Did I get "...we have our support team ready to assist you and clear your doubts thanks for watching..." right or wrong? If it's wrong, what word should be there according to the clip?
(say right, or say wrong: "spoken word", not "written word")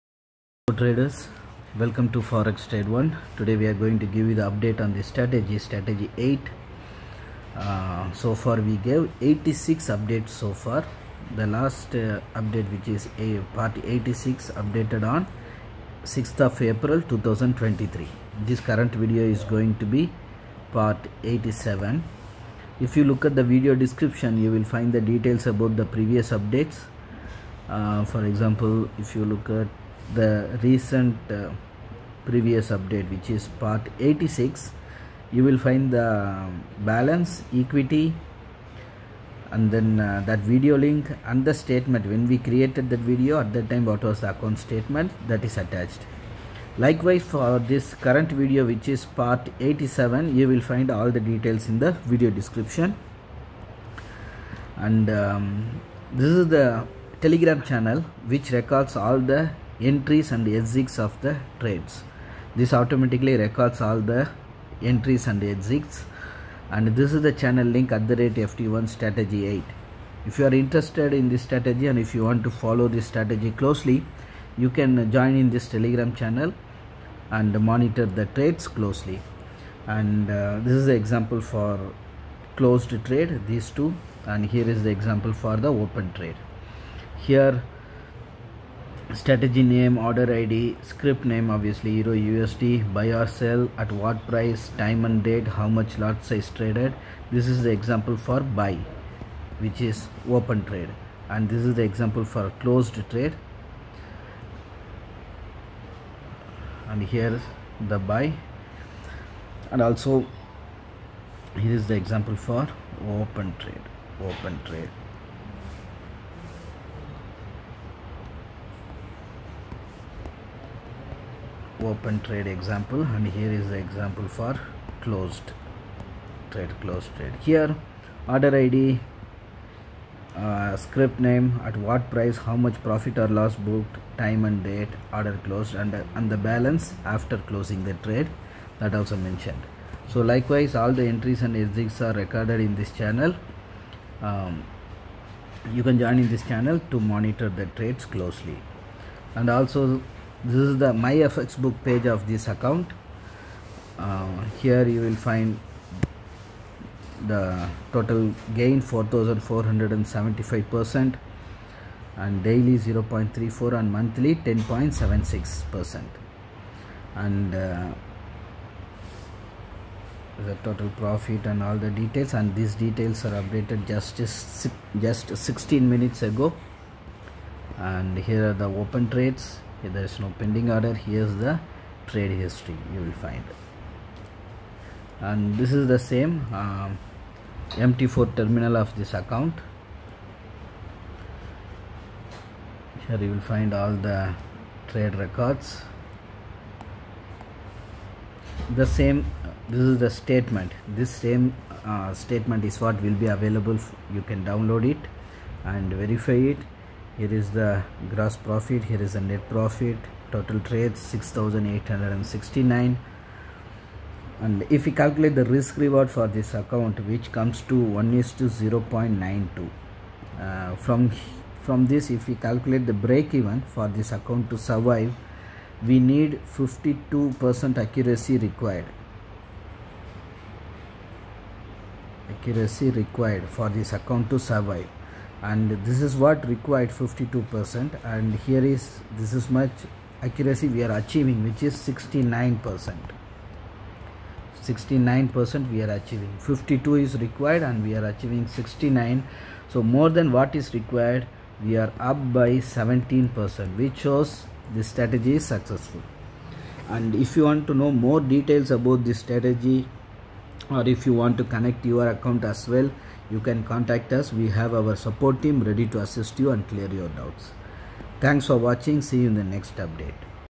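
right.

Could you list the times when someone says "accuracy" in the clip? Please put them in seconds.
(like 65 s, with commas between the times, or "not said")
227 s, 232 s, 240 s.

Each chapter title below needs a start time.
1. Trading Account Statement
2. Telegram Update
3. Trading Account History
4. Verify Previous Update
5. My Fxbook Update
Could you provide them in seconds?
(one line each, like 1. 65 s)
1. 200 s
2. 55 s
3. 185 s
4. 30 s
5. 150 s.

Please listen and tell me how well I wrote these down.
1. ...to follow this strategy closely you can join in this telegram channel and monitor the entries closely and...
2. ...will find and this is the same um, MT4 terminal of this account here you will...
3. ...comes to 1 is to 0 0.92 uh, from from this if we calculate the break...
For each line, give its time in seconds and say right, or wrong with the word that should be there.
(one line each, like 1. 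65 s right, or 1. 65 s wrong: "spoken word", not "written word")
1. 72 s wrong: "trades", not "entries"
2. 183 s right
3. 217 s right.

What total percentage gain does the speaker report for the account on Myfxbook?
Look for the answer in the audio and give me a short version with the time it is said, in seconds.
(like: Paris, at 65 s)
4475 percent, at 158 s.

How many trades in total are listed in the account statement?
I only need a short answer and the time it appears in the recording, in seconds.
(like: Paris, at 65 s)
6869, at 210 s.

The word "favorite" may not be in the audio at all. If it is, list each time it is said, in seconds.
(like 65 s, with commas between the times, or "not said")
not said.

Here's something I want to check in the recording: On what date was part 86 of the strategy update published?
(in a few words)
6th of April 2023.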